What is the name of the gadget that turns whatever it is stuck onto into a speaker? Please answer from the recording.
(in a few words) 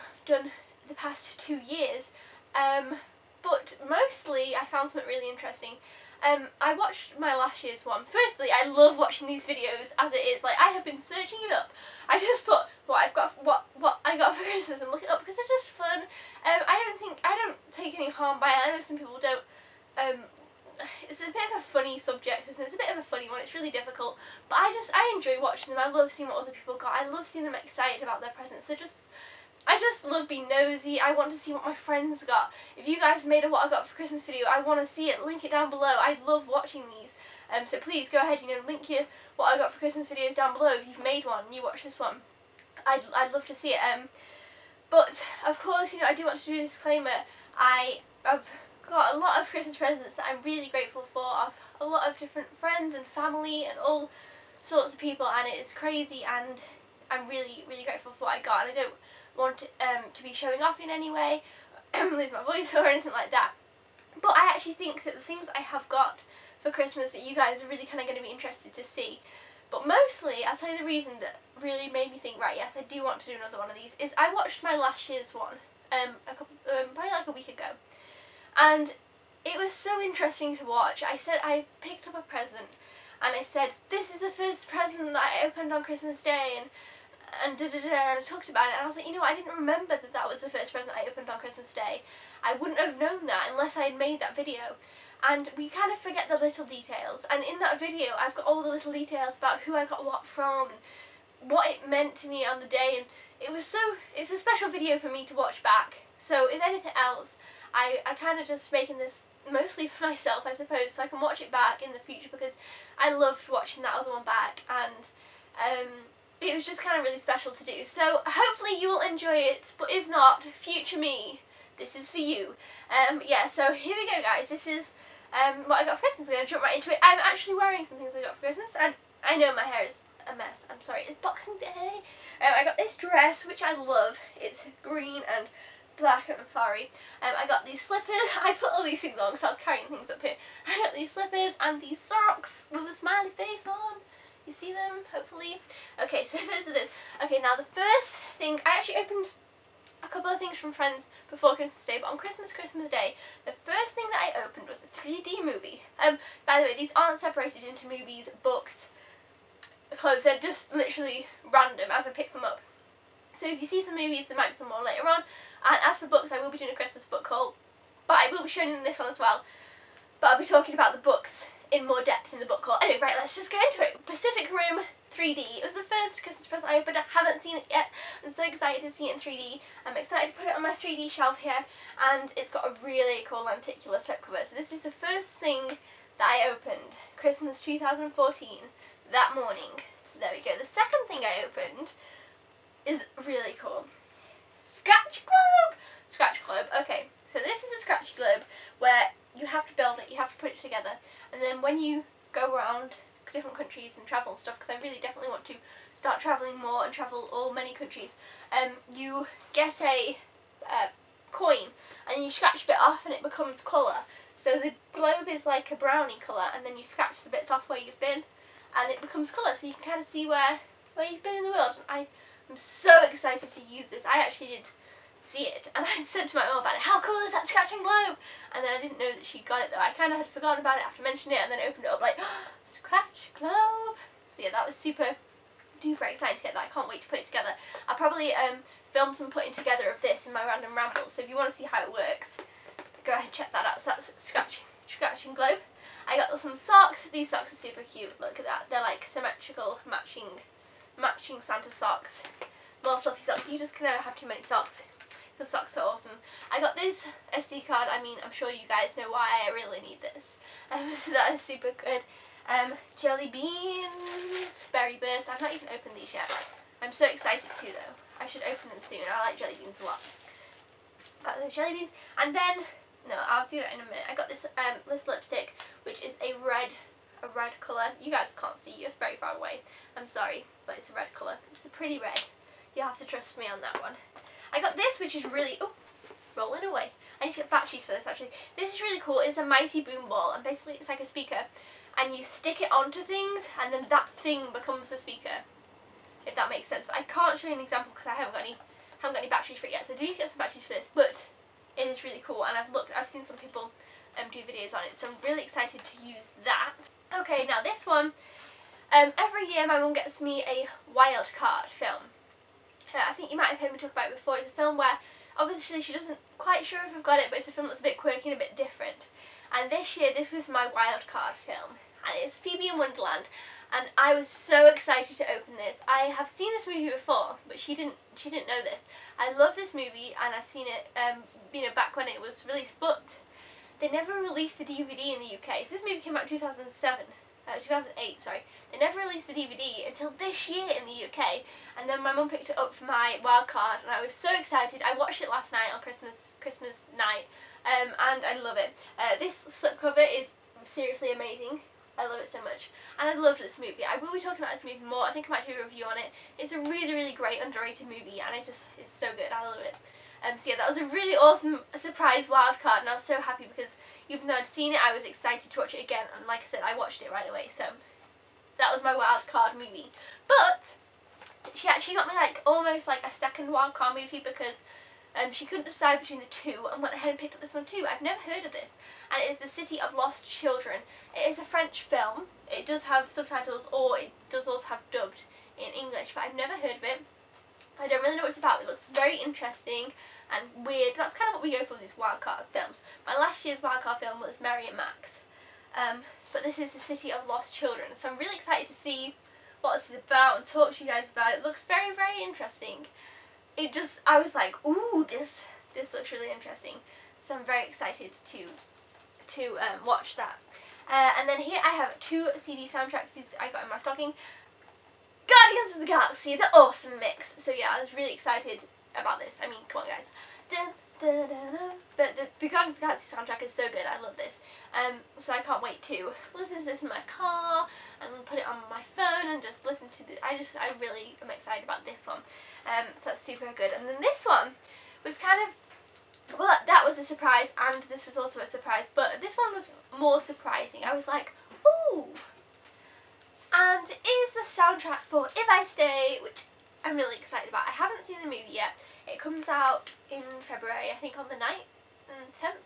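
Mighty boom ball.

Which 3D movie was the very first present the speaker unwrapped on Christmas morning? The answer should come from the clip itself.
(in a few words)
Pacific Rim.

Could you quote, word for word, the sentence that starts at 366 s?
And like I said, I watched it right away.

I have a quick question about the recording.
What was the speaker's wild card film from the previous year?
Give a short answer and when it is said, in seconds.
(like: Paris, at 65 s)
Mary and Max, at 394 s.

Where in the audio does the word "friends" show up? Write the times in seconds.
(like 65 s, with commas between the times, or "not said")
31 s, 52 s, 150 s.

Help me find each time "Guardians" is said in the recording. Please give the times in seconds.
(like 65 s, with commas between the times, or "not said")
415 s, 422 s.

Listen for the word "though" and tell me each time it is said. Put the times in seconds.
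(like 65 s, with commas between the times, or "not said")
229 s, 267 s, 364 s.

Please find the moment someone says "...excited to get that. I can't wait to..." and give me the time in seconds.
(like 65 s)
236 s.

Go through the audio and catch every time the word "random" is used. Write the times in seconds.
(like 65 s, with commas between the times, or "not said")
161 s, 240 s.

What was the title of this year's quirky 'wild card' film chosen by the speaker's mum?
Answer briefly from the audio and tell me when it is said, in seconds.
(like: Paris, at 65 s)
Phoebe in Wonderland, at 322 s.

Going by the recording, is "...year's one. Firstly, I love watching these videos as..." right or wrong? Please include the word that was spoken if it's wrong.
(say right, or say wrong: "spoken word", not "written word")
right.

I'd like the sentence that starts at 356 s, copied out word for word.
It's a really, really great underrated movie and it just it's so good.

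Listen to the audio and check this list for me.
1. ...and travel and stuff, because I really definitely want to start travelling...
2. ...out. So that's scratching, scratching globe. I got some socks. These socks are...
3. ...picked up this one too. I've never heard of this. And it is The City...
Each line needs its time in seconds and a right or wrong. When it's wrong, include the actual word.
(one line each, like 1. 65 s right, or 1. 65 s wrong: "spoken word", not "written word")
1. 203 s right
2. 243 s right
3. 377 s right.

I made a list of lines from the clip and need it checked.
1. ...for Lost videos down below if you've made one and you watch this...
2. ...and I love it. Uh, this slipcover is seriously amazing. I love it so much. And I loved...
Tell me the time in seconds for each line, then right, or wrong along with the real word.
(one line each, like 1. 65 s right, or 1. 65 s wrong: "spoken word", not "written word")
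1. 39 s wrong: "Christmas", not "Lost"
2. 348 s right.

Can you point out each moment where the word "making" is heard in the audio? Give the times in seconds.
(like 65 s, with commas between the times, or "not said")
108 s.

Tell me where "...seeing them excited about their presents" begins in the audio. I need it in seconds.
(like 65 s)
27 s.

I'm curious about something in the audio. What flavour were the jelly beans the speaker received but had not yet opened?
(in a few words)
Berry burst.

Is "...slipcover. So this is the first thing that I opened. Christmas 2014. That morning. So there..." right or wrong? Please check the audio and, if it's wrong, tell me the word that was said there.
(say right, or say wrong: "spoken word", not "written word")
right.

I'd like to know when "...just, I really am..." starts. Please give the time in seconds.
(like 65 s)
430 s.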